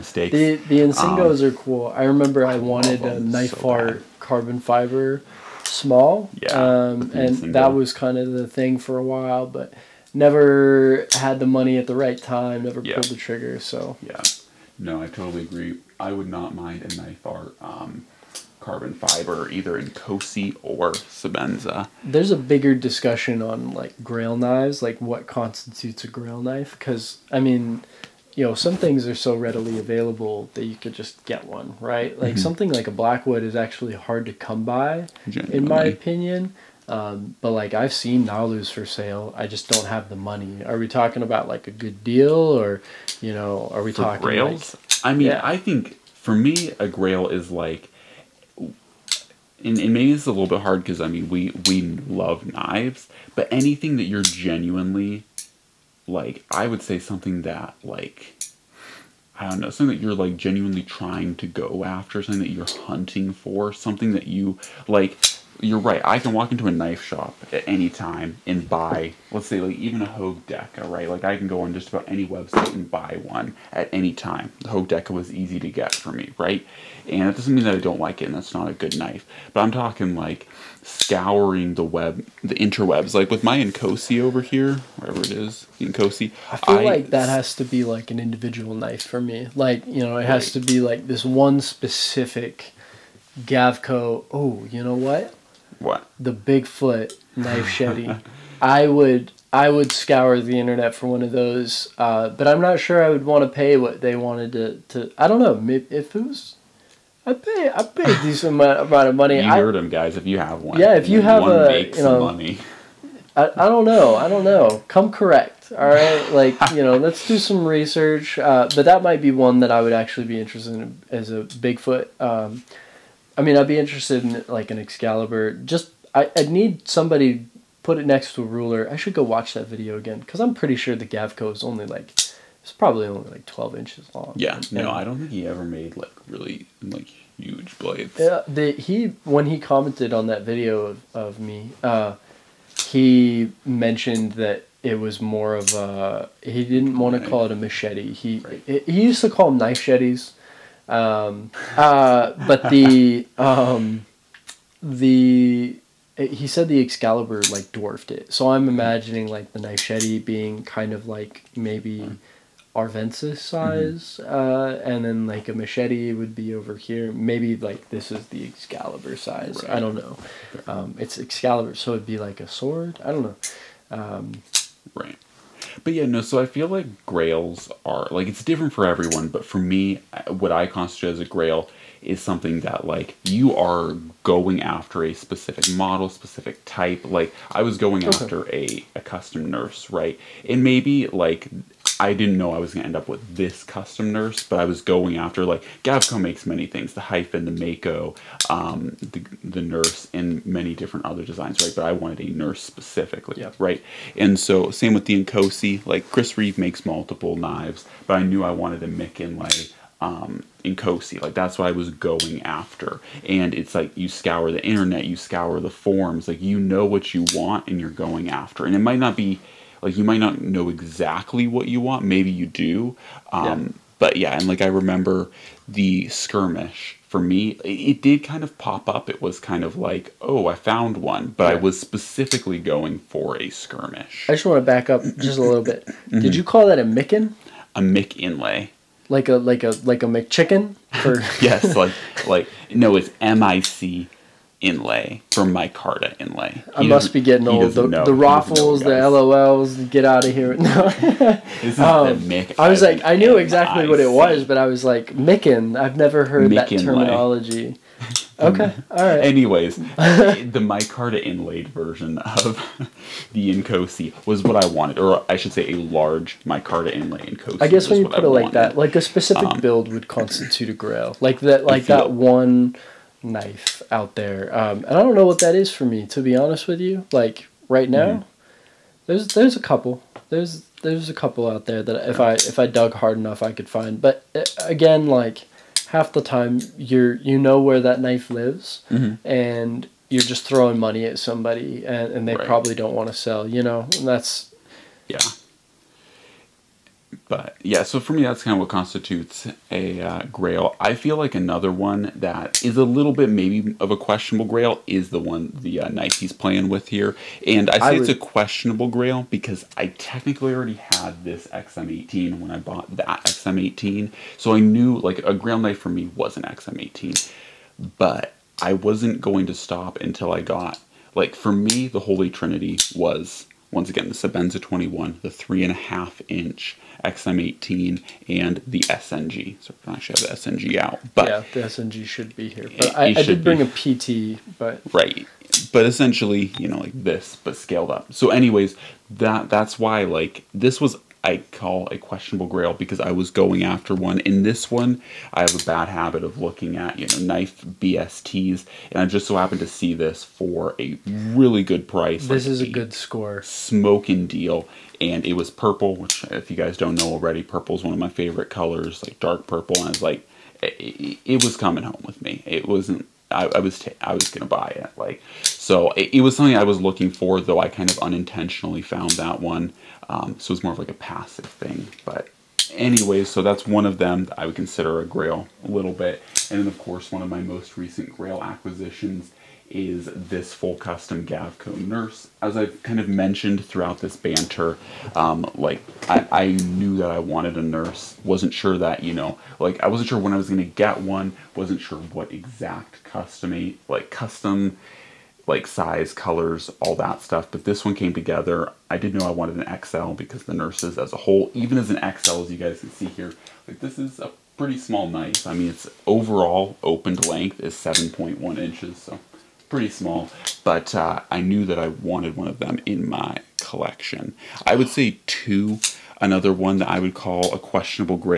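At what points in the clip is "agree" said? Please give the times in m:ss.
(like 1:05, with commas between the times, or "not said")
0:15.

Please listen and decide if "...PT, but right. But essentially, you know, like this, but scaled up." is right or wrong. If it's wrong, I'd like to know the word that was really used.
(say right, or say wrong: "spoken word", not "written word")
right.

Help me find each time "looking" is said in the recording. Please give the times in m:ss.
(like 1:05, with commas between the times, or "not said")
5:46, 6:06.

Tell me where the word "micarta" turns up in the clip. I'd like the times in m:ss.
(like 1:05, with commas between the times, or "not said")
4:05, 4:20, 4:26.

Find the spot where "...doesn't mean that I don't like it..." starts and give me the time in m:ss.
1:17.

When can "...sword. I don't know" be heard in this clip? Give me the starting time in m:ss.
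2:52.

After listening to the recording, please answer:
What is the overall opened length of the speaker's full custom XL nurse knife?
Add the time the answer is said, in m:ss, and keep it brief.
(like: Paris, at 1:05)
7.1 inches, at 6:47.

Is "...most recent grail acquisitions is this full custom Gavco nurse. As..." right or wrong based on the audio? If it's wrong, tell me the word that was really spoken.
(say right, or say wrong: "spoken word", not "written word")
right.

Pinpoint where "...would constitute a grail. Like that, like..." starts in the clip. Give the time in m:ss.
4:29.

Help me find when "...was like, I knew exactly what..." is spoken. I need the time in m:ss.
4:12.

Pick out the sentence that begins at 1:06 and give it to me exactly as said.
I can walk into a knife shop at any time and buy, let's say, like even a Hogue deck.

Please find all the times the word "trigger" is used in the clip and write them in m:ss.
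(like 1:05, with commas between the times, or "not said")
0:13.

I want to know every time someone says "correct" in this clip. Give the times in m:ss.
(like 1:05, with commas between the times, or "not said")
1:55.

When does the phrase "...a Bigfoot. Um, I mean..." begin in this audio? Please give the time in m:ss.
2:01.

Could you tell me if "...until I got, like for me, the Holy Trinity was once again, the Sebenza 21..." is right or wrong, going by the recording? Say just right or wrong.
right.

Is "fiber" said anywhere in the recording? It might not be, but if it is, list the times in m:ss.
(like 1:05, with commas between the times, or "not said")
0:04, 0:18.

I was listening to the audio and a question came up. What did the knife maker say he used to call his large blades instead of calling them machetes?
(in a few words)
knife shettes.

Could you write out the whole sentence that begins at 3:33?
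And it's like you scour the internet, you scour the forums, like you know what you want and you're going after.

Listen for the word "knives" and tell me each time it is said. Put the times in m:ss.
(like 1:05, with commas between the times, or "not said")
0:24, 0:52, 3:27.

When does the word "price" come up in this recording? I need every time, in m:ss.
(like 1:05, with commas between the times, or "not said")
5:51.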